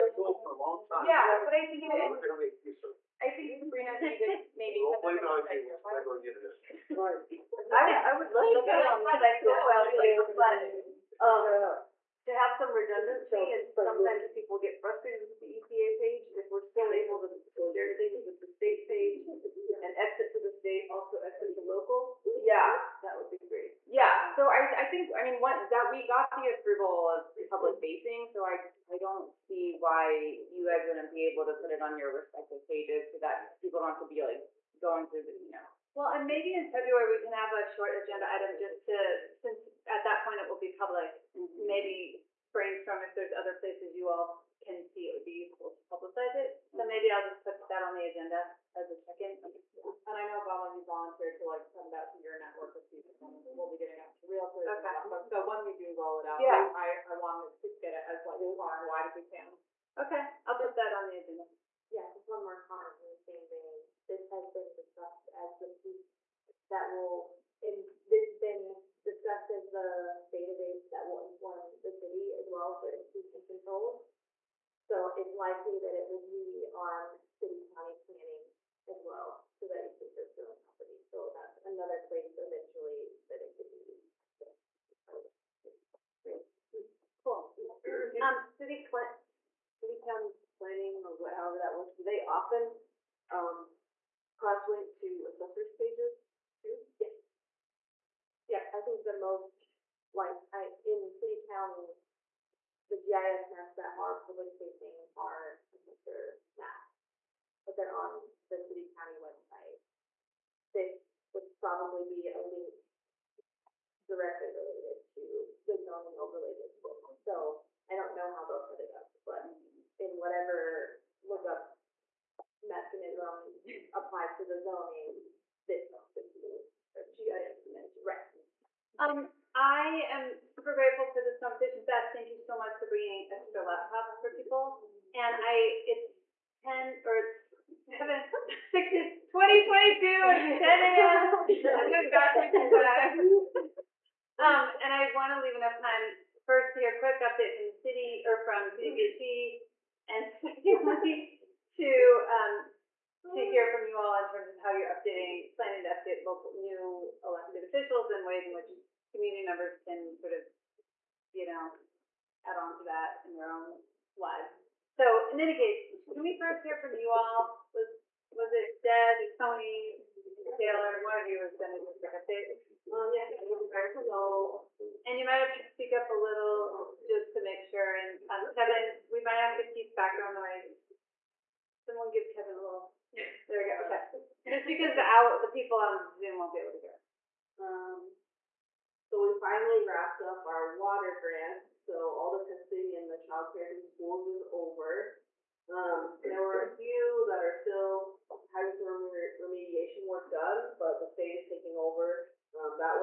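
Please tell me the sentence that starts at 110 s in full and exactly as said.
This would probably be a link directly related to the zoning overlay district.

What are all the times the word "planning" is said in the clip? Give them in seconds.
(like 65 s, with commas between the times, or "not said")
78 s, 90 s, 155 s.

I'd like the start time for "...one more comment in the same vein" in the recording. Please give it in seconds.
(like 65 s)
62 s.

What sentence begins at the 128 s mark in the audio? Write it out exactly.
Um, I am super grateful for this conversation.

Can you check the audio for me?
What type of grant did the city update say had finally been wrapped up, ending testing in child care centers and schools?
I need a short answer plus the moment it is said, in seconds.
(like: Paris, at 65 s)
water grant, at 190 s.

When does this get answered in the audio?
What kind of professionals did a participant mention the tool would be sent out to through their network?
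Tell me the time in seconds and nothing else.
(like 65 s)
54 s.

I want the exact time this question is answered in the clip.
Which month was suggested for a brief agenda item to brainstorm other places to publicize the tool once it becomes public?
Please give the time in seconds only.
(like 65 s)
36 s.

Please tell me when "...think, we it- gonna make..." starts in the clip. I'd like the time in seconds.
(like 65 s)
1 s.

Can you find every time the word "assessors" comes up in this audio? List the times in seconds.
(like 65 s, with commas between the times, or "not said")
95 s, 105 s.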